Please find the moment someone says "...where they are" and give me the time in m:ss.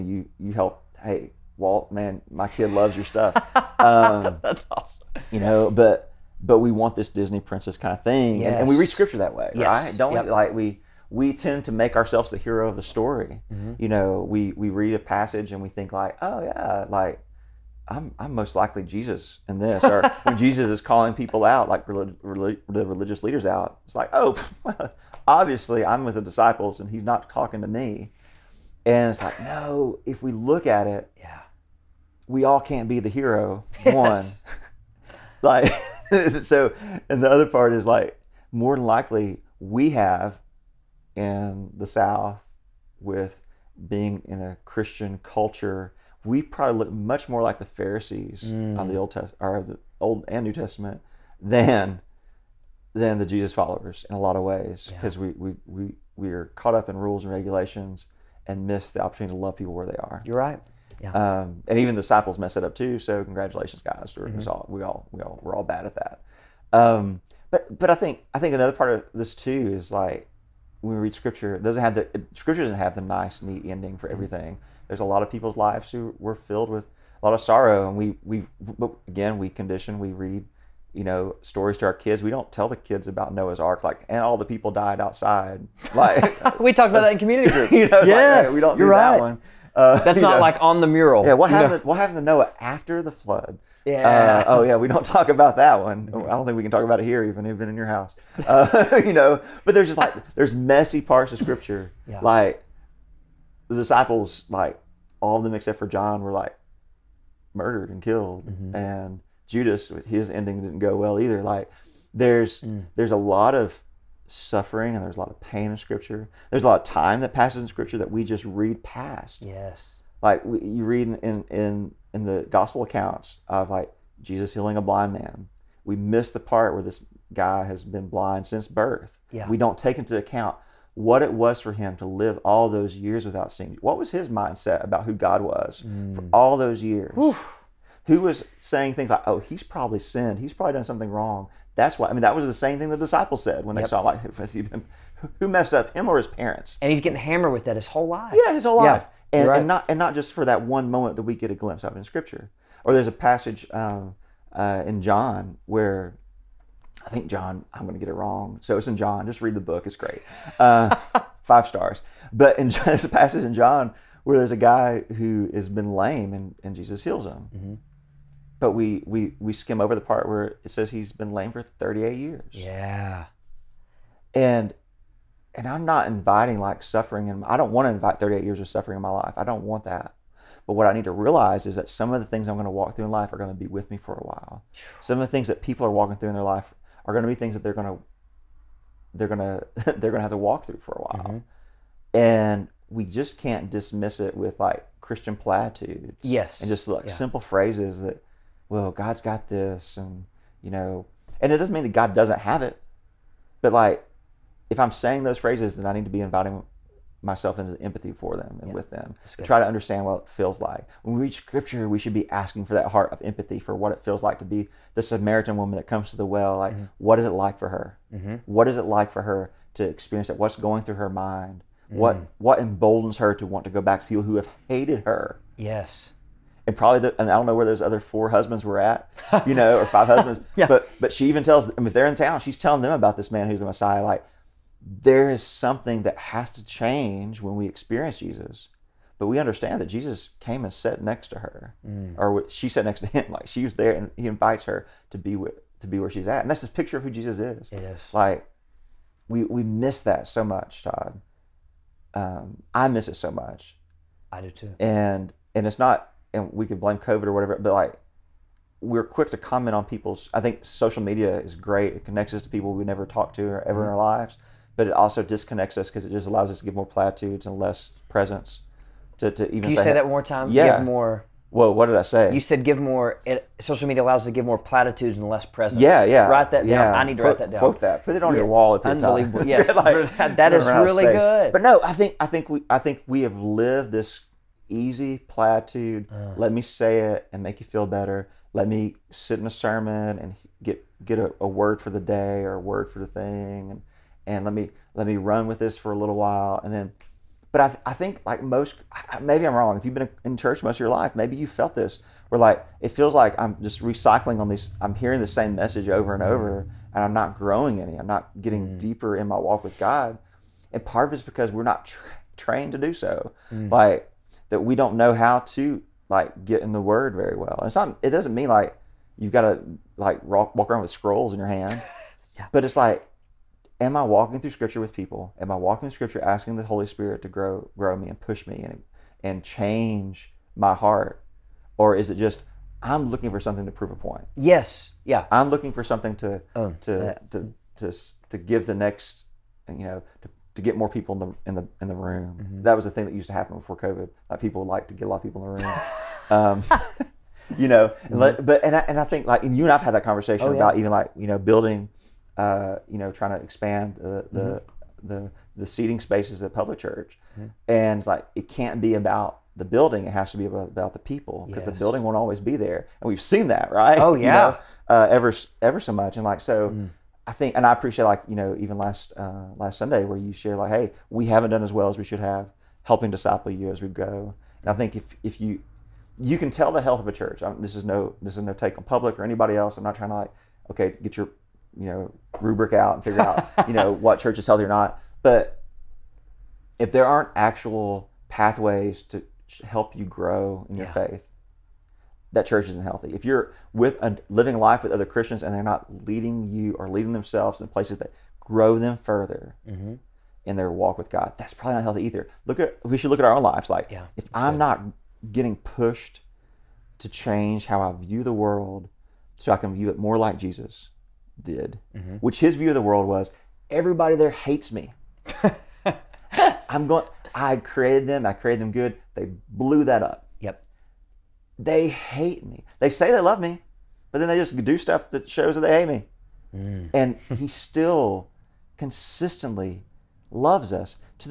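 0:59.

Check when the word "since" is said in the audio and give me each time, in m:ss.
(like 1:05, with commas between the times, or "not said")
2:08.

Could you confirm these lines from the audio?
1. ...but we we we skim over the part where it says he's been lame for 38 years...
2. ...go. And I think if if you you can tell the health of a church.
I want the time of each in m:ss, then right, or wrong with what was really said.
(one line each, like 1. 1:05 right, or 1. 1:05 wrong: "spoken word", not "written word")
1. 2:48 right
2. 6:13 right.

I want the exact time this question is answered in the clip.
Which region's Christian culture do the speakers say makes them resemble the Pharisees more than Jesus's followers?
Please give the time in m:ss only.
0:41.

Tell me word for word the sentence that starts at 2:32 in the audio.
Or there's a passage um, uh, in John where I think John, I'm going to get it wrong.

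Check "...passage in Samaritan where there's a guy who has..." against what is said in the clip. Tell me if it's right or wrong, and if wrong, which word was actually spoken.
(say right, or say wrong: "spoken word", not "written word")
wrong: "John", not "Samaritan".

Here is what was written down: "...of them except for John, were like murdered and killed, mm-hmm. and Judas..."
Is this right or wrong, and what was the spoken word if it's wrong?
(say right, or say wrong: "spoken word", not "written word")
right.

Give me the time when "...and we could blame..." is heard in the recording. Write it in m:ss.
4:16.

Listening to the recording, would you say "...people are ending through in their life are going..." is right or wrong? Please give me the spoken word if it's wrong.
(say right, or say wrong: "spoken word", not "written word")
wrong: "walking", not "ending".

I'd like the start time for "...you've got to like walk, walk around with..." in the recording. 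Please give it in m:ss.
5:19.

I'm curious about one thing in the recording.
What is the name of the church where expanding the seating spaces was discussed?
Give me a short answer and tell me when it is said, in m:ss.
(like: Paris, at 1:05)
Public Church, at 5:56.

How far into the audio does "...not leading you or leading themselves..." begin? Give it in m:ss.
6:35.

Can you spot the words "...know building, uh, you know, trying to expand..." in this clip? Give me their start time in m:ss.
5:51.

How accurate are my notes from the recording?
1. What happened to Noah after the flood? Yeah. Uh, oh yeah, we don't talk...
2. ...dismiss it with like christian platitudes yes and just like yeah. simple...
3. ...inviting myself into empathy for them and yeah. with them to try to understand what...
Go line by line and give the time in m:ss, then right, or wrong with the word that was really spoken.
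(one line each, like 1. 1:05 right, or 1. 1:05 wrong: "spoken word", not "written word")
1. 1:31 right
2. 3:13 right
3. 3:26 right.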